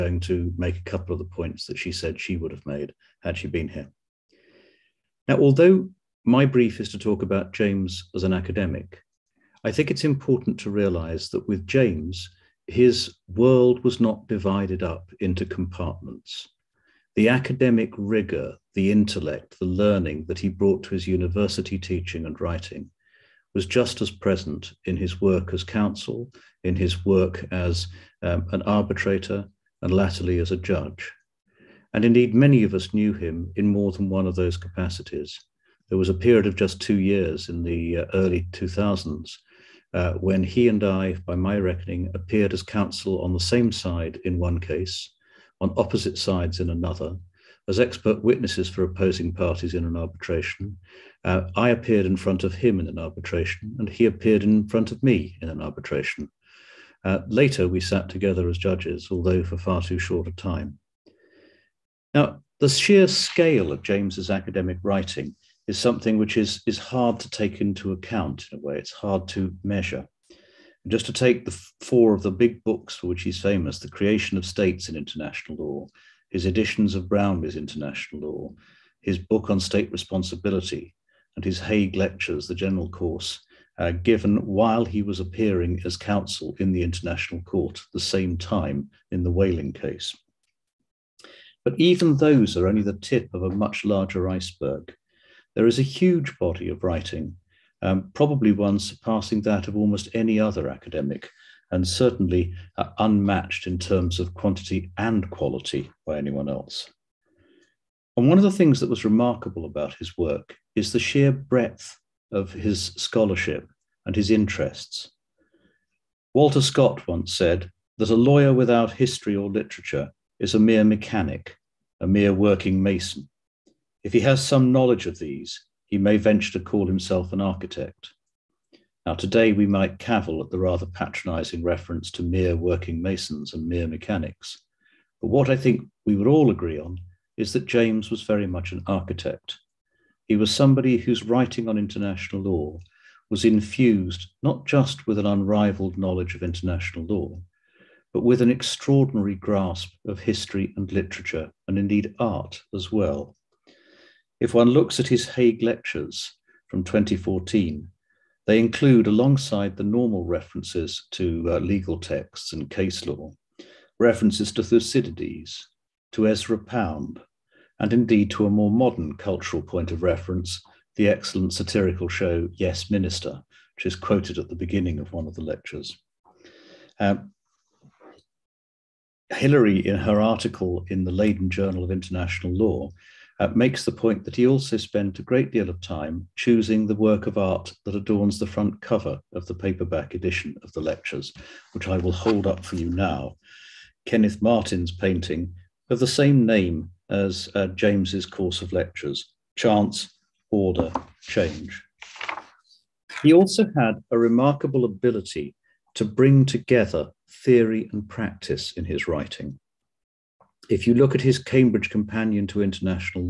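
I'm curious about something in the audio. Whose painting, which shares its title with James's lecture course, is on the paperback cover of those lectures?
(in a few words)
Kenneth Martin.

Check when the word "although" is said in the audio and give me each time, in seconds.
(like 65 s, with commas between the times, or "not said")
5 s, 59 s.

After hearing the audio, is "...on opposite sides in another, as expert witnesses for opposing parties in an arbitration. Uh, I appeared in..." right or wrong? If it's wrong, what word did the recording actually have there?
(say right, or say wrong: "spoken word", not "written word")
right.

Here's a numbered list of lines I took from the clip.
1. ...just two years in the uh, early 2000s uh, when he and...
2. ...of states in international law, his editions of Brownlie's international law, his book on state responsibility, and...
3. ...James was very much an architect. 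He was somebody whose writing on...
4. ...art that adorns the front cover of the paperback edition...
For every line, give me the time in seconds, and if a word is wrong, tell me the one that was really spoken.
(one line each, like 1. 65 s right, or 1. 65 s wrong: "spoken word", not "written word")
1. 36 s right
2. 74 s right
3. 137 s right
4. 187 s right.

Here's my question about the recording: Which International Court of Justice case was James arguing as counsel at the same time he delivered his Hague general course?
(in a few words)
Whaling case.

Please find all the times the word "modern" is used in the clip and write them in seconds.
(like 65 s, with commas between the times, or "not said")
168 s.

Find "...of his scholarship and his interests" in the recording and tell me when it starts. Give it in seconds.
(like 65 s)
112 s.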